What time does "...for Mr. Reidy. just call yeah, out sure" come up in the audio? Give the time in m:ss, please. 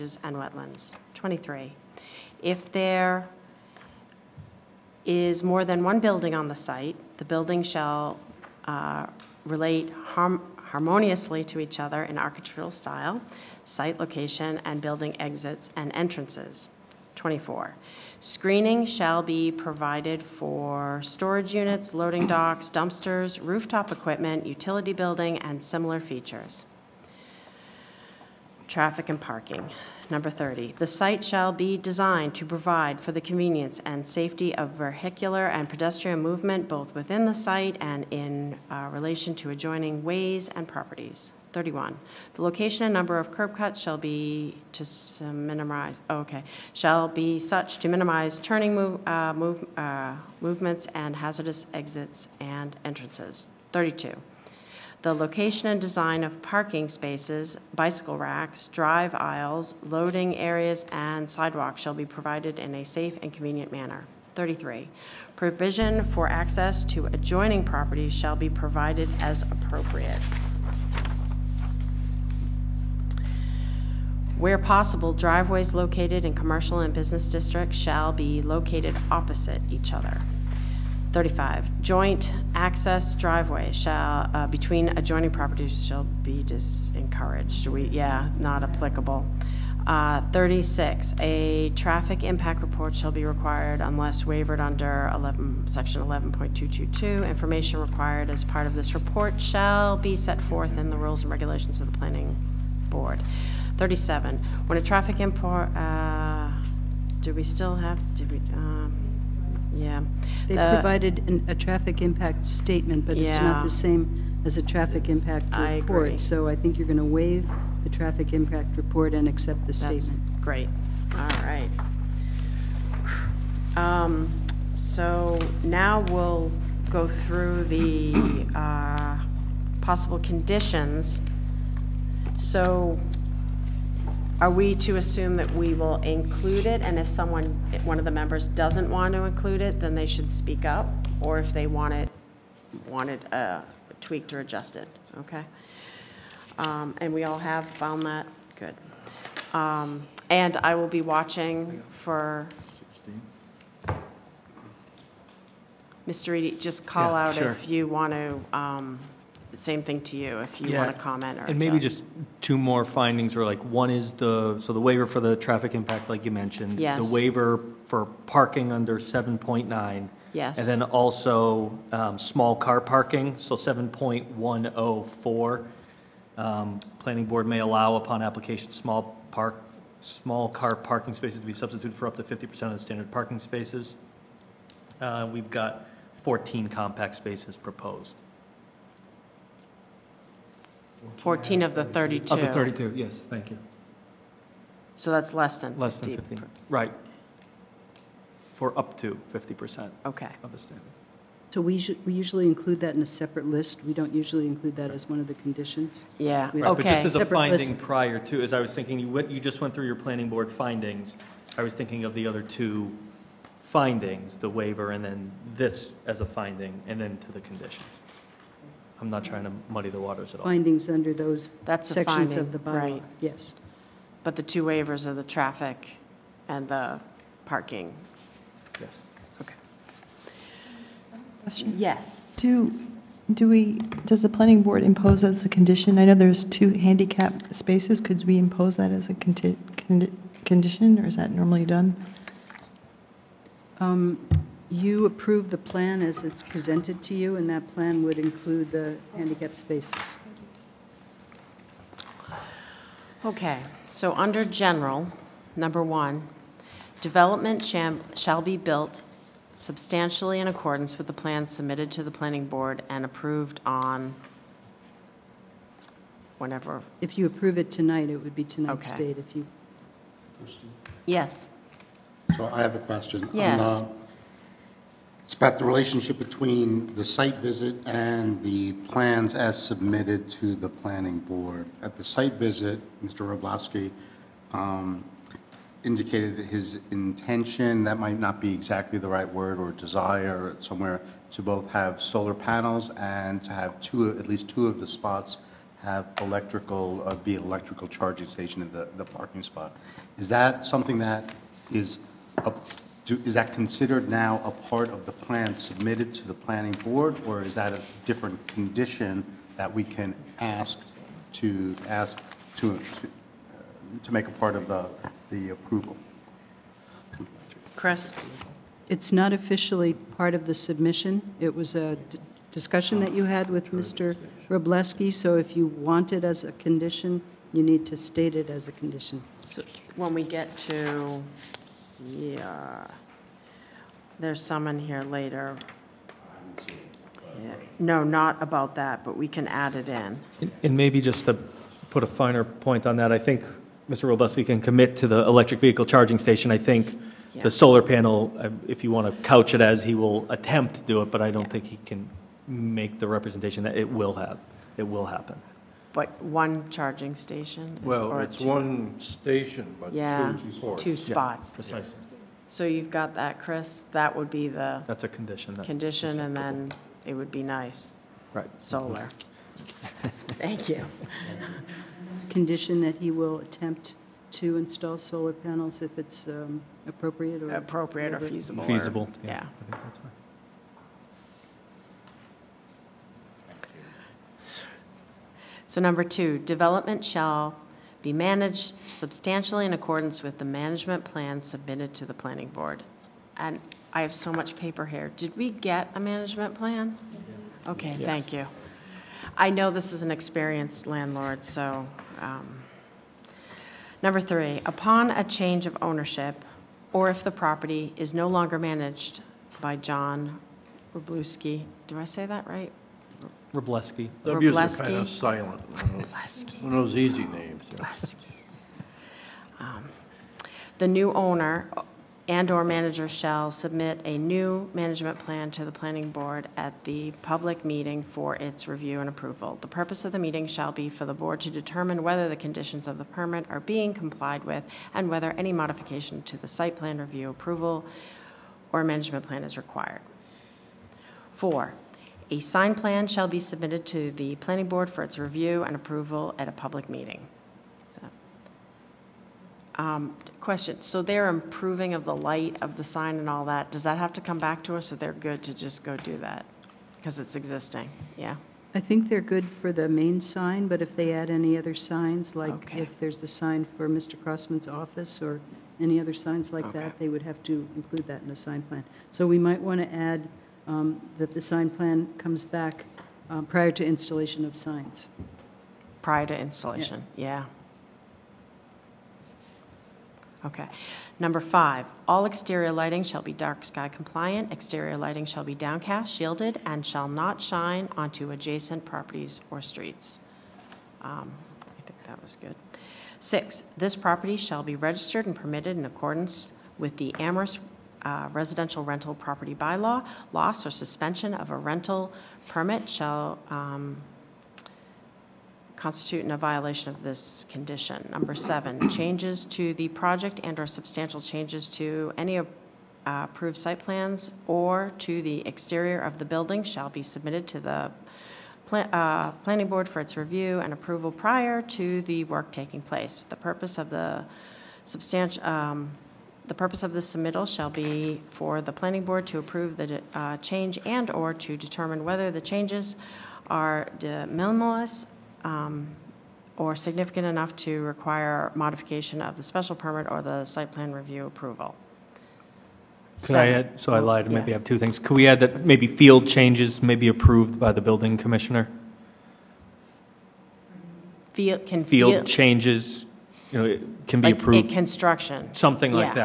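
2:31.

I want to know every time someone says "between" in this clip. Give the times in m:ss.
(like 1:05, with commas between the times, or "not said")
1:24, 4:36.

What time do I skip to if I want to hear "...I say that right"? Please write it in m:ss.
6:51.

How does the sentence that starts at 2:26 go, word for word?
Um, and we all have found that, good.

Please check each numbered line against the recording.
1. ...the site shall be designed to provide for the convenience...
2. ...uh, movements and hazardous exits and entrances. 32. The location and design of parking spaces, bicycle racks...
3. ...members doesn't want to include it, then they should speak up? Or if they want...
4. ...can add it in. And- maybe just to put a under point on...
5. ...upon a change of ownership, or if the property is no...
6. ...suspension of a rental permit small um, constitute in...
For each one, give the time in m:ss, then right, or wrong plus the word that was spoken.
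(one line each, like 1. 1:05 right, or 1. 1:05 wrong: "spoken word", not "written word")
1. 0:30 right
2. 0:49 right
3. 2:18 right
4. 5:39 wrong: "finer", not "under"
5. 6:44 right
6. 8:20 wrong: "shall", not "small".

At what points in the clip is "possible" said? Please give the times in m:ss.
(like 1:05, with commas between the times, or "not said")
1:14, 2:09.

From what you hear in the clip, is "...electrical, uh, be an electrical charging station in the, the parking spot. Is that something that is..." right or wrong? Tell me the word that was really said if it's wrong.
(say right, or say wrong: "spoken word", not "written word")
right.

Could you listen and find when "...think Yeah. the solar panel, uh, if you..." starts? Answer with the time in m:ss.
5:46.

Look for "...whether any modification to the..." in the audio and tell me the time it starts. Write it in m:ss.
7:15.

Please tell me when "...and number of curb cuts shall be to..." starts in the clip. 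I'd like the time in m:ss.
0:42.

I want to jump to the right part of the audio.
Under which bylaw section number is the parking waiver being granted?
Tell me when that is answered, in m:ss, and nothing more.
2:48.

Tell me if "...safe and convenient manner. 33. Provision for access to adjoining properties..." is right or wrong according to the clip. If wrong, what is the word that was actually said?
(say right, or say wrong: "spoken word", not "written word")
right.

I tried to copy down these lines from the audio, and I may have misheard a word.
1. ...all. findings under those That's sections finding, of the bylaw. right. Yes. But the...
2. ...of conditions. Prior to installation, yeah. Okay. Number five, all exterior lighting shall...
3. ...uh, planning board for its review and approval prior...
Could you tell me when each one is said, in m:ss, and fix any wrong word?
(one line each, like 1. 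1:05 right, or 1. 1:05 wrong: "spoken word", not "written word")
1. 3:40 right
2. 7:54 wrong: "signs", not "conditions"
3. 8:38 right.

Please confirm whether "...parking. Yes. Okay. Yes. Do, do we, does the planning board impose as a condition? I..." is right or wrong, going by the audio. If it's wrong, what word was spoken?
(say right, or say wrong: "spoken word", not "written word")
right.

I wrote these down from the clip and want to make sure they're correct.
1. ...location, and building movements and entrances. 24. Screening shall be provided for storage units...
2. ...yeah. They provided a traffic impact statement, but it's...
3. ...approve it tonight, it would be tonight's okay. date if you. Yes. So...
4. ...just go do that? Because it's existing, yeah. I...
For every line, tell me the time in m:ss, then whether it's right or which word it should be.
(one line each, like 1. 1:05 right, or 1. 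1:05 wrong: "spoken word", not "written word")
1. 0:13 wrong: "exits", not "movements"
2. 1:49 right
3. 4:27 right
4. 7:35 right.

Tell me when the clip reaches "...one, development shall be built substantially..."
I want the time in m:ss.
4:15.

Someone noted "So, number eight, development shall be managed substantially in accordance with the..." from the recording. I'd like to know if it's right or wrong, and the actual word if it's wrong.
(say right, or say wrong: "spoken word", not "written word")
wrong: "two", not "eight".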